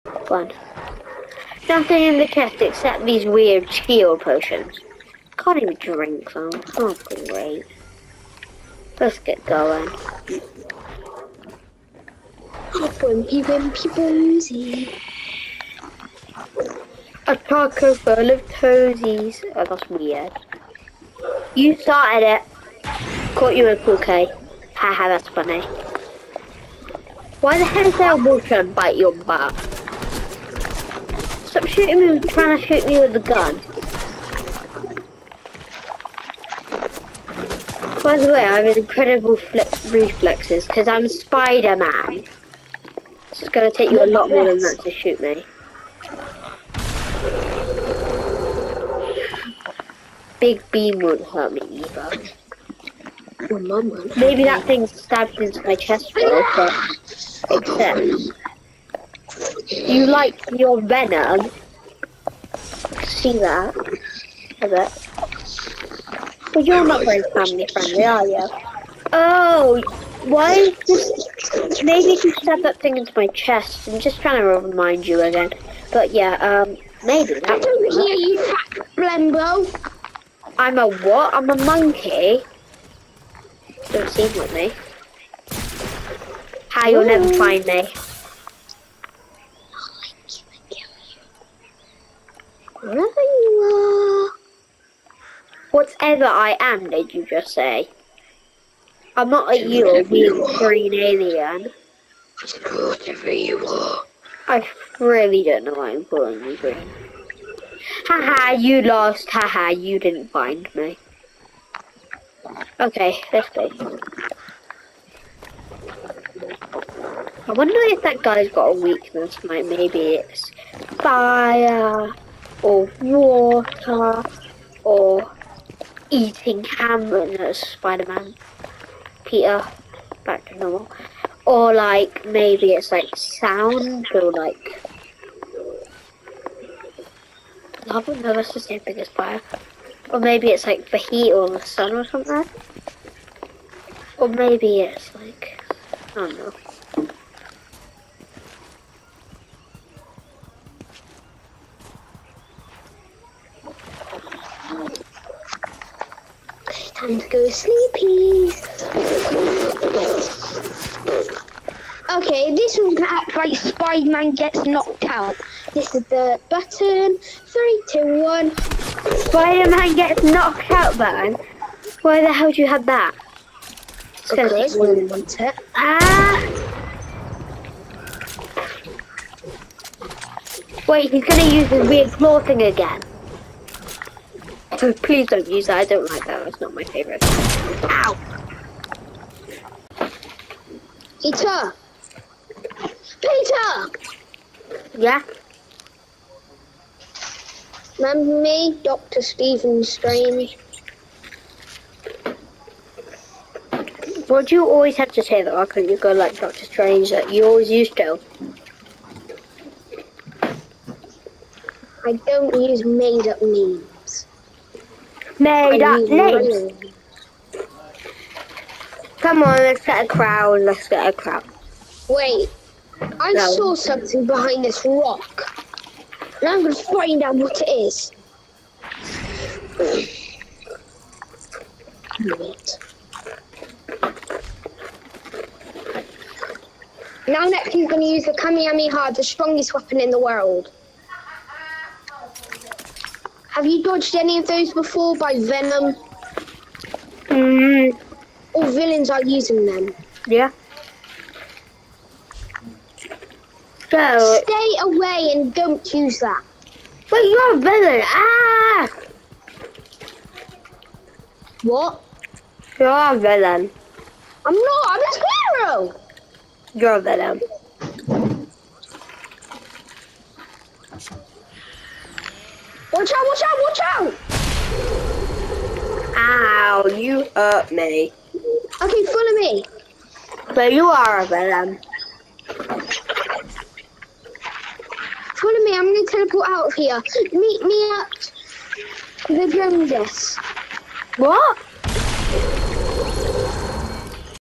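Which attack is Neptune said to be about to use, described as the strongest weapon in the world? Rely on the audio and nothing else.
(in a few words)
Kamehameha.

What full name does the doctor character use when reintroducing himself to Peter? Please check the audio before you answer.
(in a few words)
Dr. Stephen Strange.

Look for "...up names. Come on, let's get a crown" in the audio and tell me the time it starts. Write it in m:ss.
3:35.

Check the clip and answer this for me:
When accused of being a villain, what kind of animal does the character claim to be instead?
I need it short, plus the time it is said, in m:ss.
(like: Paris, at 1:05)
a squirrel, at 4:25.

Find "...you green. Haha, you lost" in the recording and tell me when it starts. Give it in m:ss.
1:46.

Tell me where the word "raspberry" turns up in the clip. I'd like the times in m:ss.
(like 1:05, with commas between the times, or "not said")
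not said.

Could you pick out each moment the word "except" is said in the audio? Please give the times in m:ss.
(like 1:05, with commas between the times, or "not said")
0:02, 0:57.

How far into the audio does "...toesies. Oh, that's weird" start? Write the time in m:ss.
0:18.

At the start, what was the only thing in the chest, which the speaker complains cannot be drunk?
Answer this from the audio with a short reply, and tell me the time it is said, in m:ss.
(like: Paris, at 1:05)
skill potions, at 0:03.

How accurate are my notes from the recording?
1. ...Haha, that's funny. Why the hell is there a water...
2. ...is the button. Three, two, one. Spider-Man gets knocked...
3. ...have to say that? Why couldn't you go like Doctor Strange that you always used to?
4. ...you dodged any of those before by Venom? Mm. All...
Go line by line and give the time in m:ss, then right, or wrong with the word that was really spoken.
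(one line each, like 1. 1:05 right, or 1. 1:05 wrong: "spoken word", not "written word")
1. 0:24 right
2. 2:45 right
3. 3:24 right
4. 4:03 right.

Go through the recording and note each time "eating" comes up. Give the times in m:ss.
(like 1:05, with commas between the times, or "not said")
2:06.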